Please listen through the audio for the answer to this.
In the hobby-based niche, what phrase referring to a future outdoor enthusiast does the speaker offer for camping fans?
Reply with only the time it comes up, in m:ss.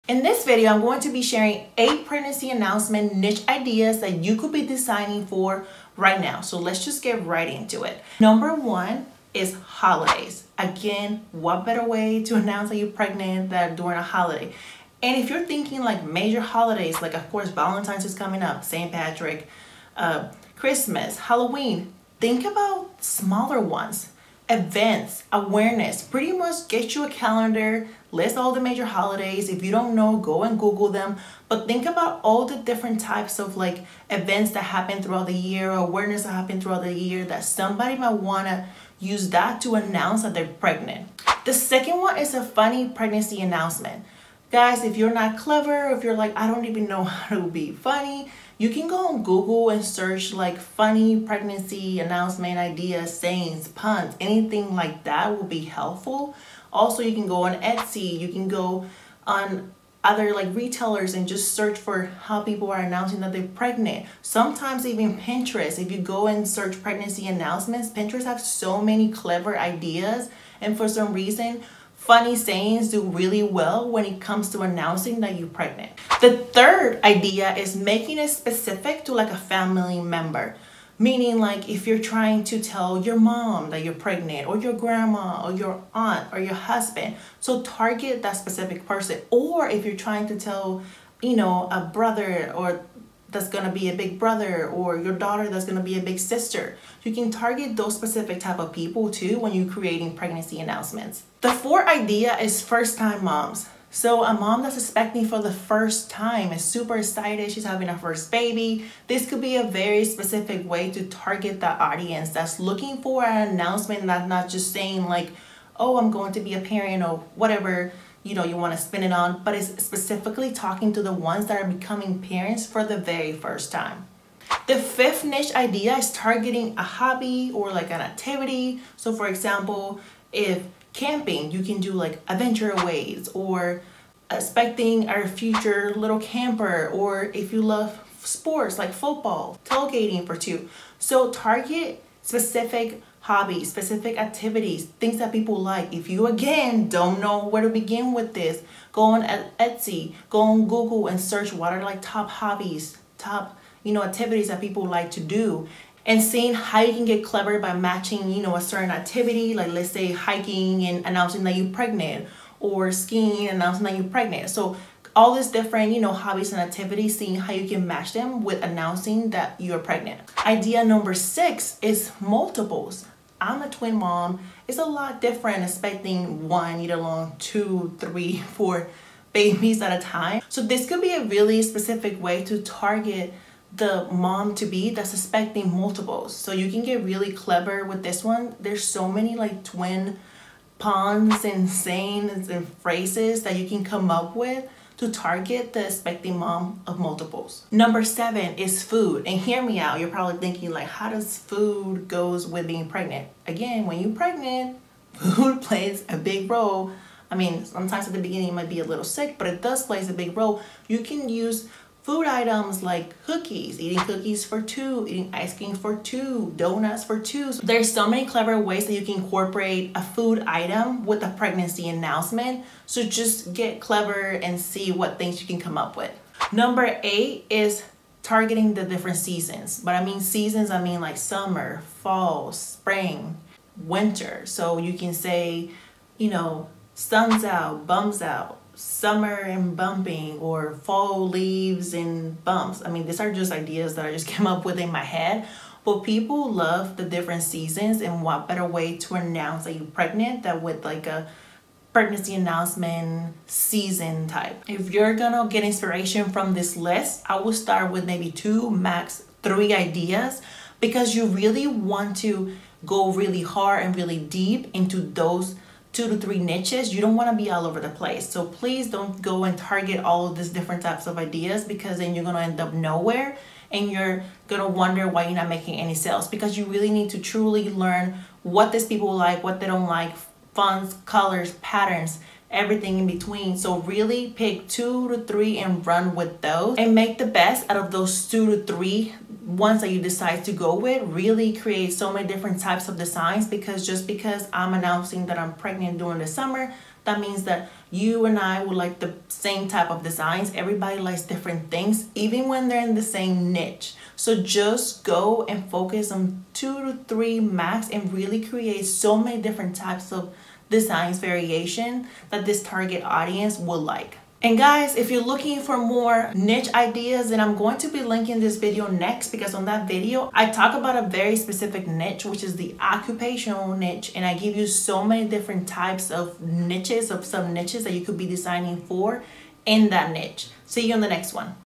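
2:15.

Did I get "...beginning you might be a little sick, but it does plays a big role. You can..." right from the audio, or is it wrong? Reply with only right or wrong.
right.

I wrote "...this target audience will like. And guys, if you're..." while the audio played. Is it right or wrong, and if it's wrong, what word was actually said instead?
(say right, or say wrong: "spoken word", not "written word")
right.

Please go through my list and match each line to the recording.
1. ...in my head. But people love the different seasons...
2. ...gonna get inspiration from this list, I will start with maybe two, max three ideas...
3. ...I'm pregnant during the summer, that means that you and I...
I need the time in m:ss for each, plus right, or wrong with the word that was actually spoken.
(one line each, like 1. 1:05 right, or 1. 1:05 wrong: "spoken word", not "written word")
1. 4:04 right
2. 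4:15 right
3. 4:55 right.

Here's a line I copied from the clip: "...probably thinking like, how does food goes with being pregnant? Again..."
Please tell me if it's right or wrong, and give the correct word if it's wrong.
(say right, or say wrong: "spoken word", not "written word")
right.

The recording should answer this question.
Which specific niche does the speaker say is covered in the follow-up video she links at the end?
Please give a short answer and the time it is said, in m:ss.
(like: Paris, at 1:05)
occupational niche, at 5:22.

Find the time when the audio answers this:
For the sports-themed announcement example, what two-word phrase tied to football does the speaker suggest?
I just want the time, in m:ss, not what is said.
2:19.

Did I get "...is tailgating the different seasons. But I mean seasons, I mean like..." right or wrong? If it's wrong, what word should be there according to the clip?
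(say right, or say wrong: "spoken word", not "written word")
wrong: "targeting", not "tailgating".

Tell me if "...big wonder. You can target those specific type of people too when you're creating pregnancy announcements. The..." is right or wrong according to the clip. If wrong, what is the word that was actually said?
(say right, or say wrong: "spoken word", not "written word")
wrong: "sister", not "wonder".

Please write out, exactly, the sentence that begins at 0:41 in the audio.
The second one is a funny pregnancy announcement.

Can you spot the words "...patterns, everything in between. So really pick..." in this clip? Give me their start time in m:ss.
4:41.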